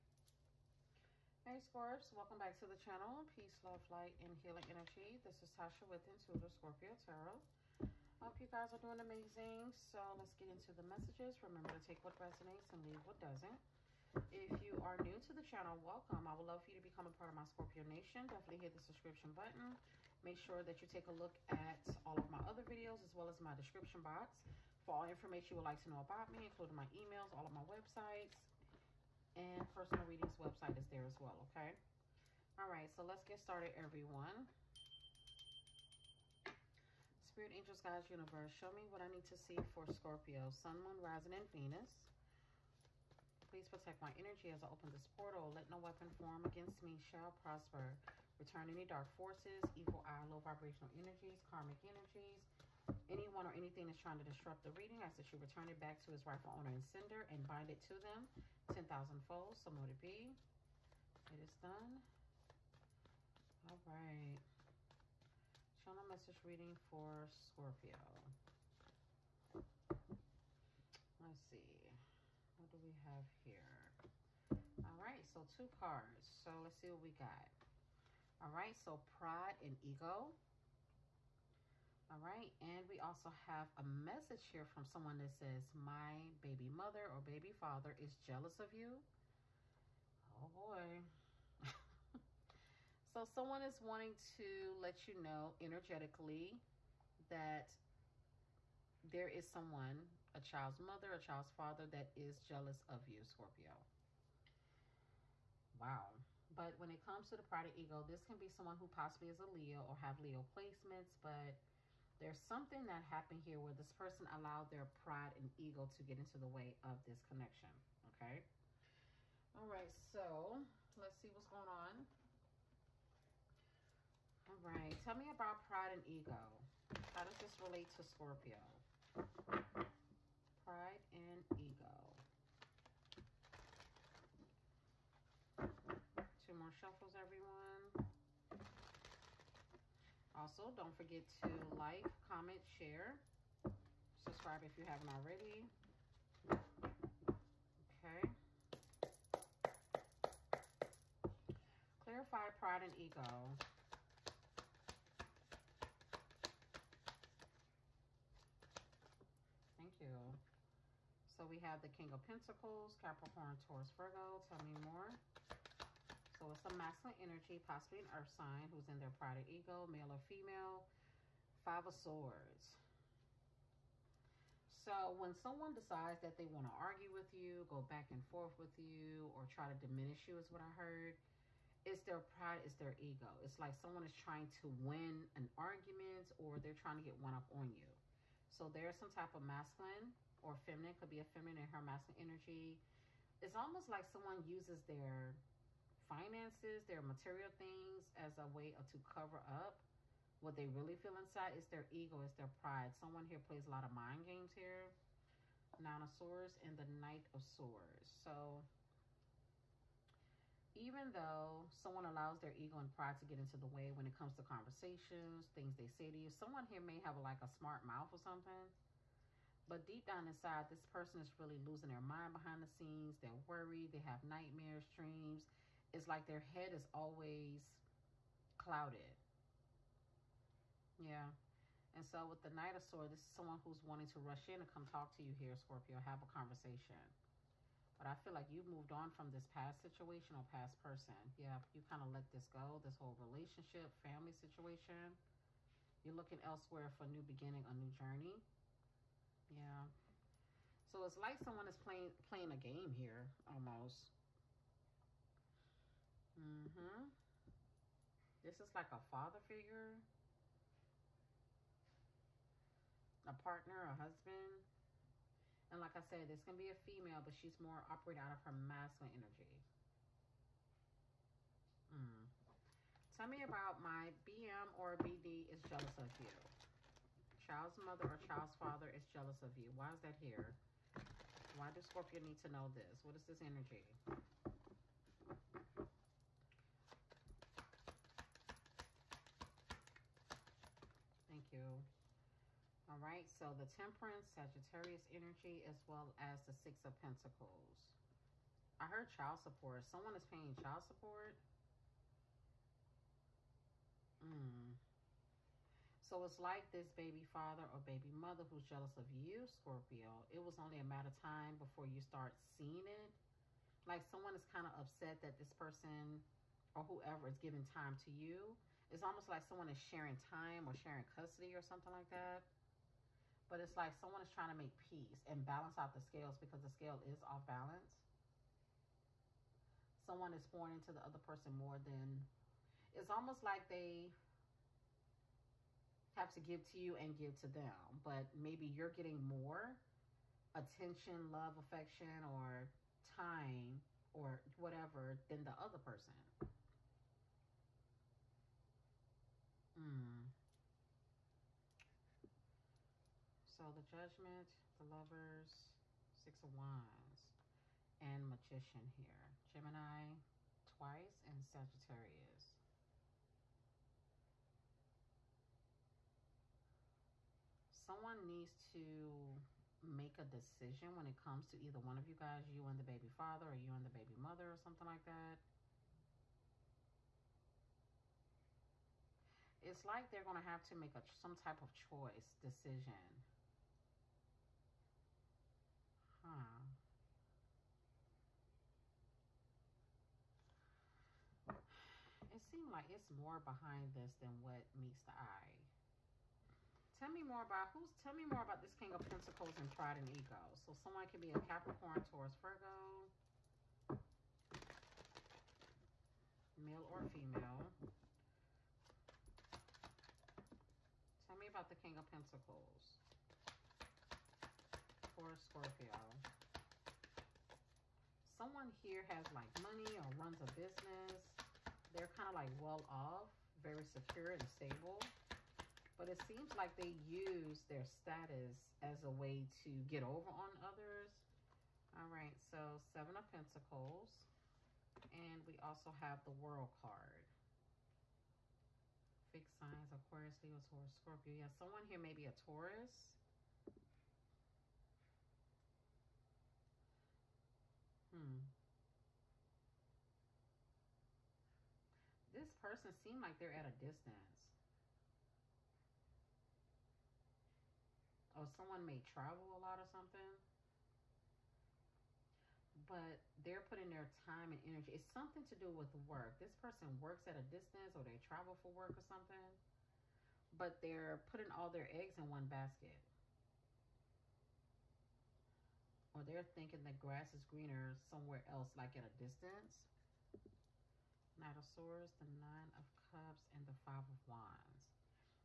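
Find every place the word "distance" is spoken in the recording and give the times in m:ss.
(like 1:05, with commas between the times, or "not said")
7:33, 7:47, 7:59.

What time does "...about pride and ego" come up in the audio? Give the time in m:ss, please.
2:05.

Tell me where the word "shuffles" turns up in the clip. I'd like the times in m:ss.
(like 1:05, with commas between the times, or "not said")
2:16.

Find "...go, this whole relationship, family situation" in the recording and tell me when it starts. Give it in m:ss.
4:02.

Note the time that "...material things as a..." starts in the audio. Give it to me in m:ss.
3:17.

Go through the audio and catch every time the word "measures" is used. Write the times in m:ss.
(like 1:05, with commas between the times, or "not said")
not said.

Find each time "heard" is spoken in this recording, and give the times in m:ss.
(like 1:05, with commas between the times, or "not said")
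3:00, 4:58.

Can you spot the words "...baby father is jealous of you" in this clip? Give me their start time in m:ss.
1:27.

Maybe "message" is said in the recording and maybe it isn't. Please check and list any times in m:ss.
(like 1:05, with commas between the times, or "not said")
0:10, 1:06, 1:23.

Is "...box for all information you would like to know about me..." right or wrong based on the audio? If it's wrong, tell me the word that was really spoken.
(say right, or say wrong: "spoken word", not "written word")
right.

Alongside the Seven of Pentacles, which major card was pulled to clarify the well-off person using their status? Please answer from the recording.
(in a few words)
The World.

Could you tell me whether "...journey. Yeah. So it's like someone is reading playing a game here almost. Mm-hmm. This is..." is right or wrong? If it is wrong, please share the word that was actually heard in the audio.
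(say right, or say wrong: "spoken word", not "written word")
wrong: "playing", not "reading".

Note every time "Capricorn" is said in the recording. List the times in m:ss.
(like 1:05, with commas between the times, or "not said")
2:42, 6:41.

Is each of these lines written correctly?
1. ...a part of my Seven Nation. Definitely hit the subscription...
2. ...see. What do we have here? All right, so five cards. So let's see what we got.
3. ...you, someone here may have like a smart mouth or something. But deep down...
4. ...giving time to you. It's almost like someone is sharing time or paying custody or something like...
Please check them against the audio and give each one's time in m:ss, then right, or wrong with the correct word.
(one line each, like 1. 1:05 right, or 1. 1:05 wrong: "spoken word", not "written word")
1. 0:17 wrong: "Scorpio", not "Seven"
2. 1:11 wrong: "two", not "five"
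3. 3:36 right
4. 5:17 wrong: "sharing", not "paying".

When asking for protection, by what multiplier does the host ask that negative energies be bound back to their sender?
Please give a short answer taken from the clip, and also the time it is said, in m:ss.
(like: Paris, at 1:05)
10,000 fold, at 0:58.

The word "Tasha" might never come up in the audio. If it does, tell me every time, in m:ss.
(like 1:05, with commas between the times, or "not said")
0:05.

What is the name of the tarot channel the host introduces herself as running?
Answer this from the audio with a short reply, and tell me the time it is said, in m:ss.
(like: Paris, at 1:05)
Intuitive Scorpio Tarot, at 0:06.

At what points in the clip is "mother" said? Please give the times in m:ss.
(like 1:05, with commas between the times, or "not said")
1:26, 1:40, 4:37, 5:08, 6:14.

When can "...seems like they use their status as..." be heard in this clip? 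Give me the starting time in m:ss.
7:06.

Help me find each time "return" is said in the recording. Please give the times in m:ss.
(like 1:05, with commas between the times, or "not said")
0:48, 0:55.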